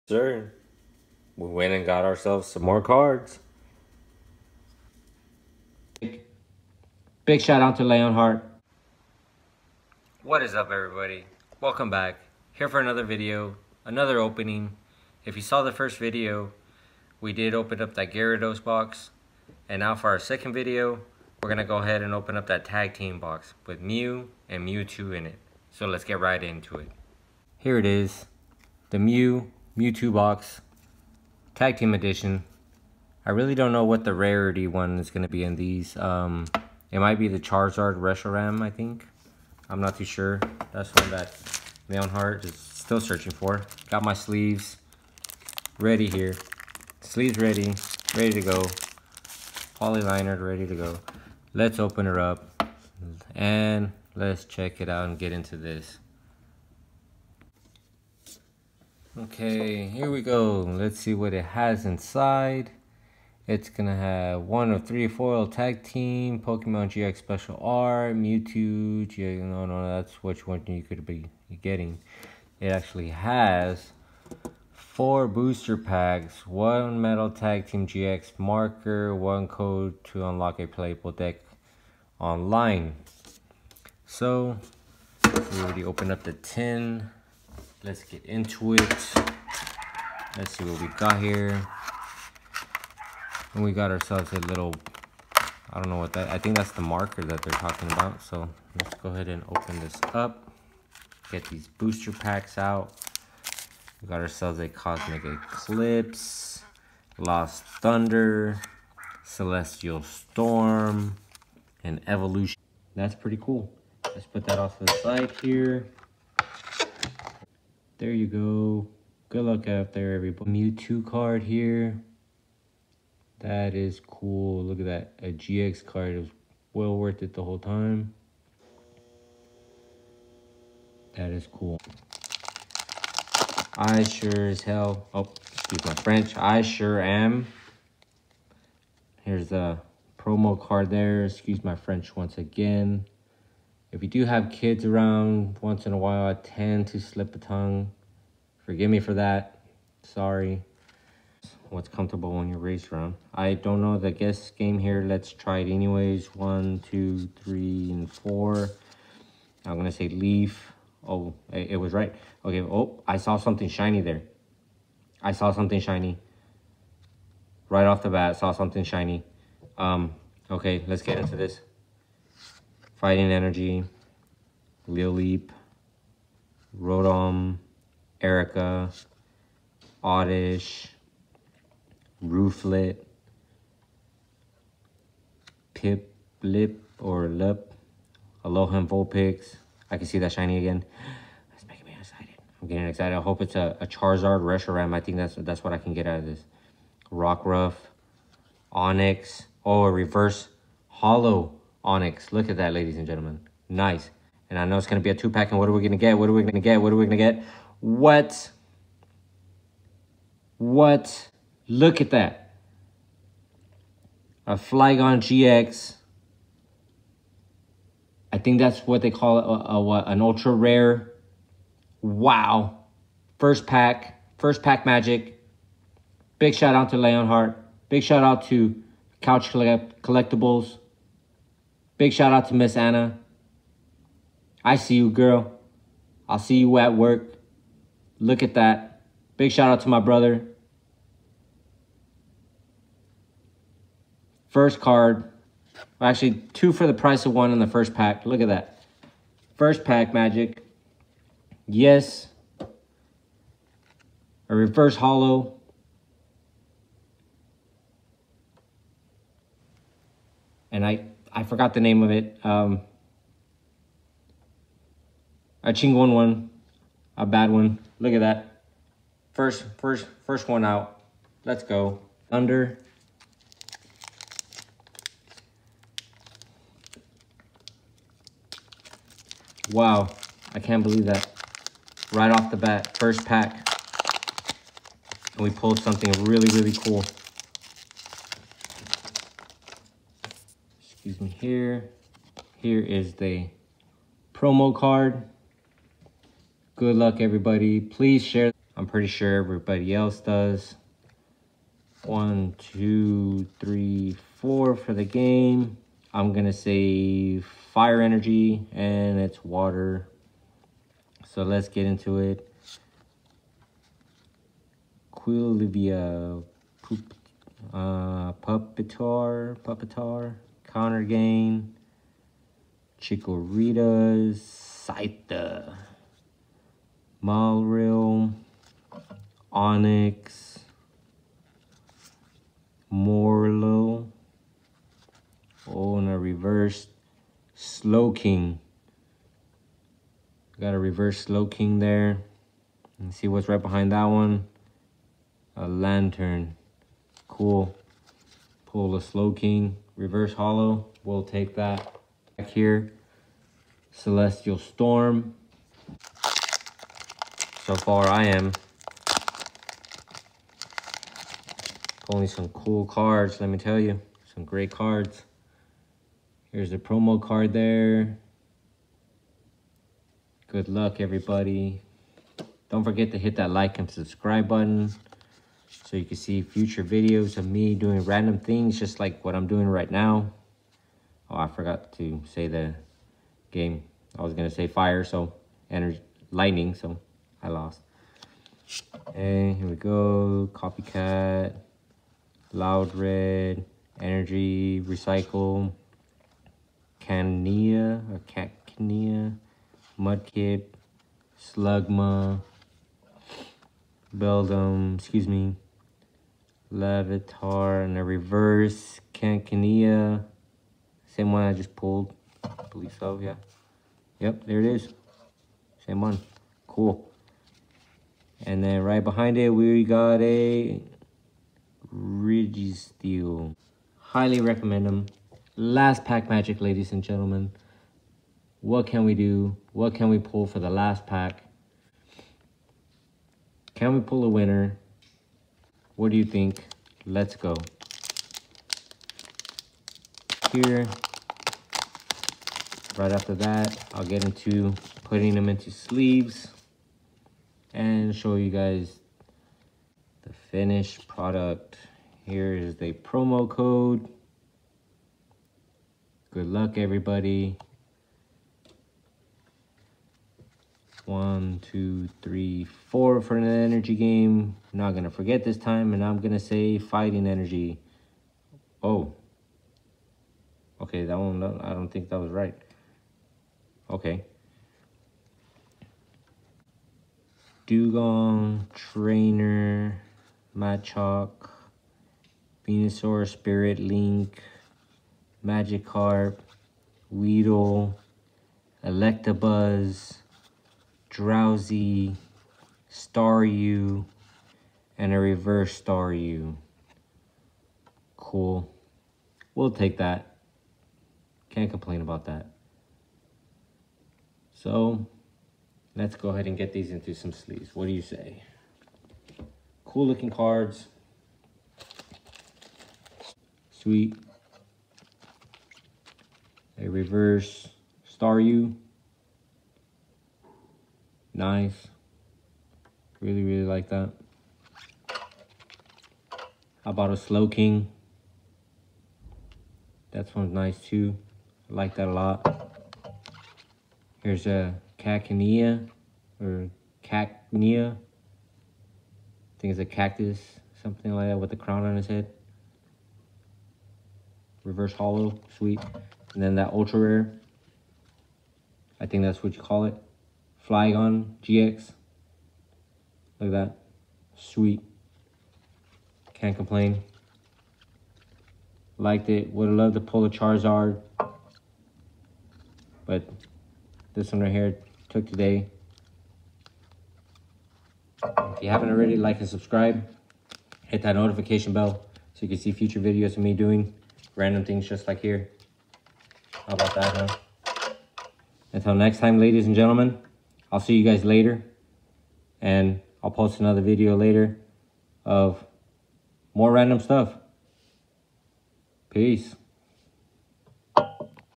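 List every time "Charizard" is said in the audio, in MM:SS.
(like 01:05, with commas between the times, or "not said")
00:37, 03:13, 09:20.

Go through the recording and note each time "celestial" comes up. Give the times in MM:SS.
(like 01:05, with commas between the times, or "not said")
01:49, 05:53.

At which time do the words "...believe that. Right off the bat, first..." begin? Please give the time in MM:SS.
04:40.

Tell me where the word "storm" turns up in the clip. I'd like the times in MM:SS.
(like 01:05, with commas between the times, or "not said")
01:50, 05:54.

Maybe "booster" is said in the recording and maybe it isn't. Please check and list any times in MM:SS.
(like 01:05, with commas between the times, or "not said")
01:15, 01:41.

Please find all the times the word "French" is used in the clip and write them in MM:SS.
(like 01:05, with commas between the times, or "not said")
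02:16, 02:21.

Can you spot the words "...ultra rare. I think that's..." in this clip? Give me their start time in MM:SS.
09:06.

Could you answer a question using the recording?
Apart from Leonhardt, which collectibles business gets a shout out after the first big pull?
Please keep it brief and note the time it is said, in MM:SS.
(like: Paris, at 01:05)
Couch Collect Collectibles, at 03:49.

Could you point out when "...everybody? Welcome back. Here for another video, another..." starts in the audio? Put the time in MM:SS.
00:10.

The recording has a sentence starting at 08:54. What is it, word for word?
Here's a uh, cacnea or cacnea.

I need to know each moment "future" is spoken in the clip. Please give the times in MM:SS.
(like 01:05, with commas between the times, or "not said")
06:16, 09:32.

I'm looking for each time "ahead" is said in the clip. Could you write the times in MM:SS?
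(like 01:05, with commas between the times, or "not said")
00:21, 01:39, 08:26.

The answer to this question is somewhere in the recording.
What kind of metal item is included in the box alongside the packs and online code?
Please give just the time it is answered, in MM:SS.
01:17.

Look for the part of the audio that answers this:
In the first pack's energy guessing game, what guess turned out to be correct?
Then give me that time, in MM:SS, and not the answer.
02:40.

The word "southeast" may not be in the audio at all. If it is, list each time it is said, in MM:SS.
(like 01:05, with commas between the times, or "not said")
not said.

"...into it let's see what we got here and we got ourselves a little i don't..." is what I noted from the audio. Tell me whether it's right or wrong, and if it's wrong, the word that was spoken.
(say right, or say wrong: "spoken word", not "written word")
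right.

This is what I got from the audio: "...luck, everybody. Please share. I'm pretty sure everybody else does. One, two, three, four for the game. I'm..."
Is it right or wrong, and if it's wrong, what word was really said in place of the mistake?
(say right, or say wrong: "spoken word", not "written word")
right.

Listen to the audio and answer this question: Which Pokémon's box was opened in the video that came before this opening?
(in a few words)
Gyarados.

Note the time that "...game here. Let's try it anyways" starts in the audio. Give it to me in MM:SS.
02:34.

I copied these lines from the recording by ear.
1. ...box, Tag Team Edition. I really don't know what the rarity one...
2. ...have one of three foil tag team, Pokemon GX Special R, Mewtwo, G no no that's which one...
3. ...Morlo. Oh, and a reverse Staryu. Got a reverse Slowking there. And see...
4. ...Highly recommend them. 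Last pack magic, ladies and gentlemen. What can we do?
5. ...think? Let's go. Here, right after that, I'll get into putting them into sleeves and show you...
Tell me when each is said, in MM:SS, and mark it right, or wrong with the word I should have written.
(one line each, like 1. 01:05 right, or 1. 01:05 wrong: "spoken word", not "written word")
1. 00:30 right
2. 01:03 right
3. 05:32 wrong: "Slowking", not "Staryu"
4. 07:03 right
5. 07:16 right.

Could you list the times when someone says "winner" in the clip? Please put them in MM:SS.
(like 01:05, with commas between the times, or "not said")
07:14.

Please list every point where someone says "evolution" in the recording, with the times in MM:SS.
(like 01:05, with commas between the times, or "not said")
01:52.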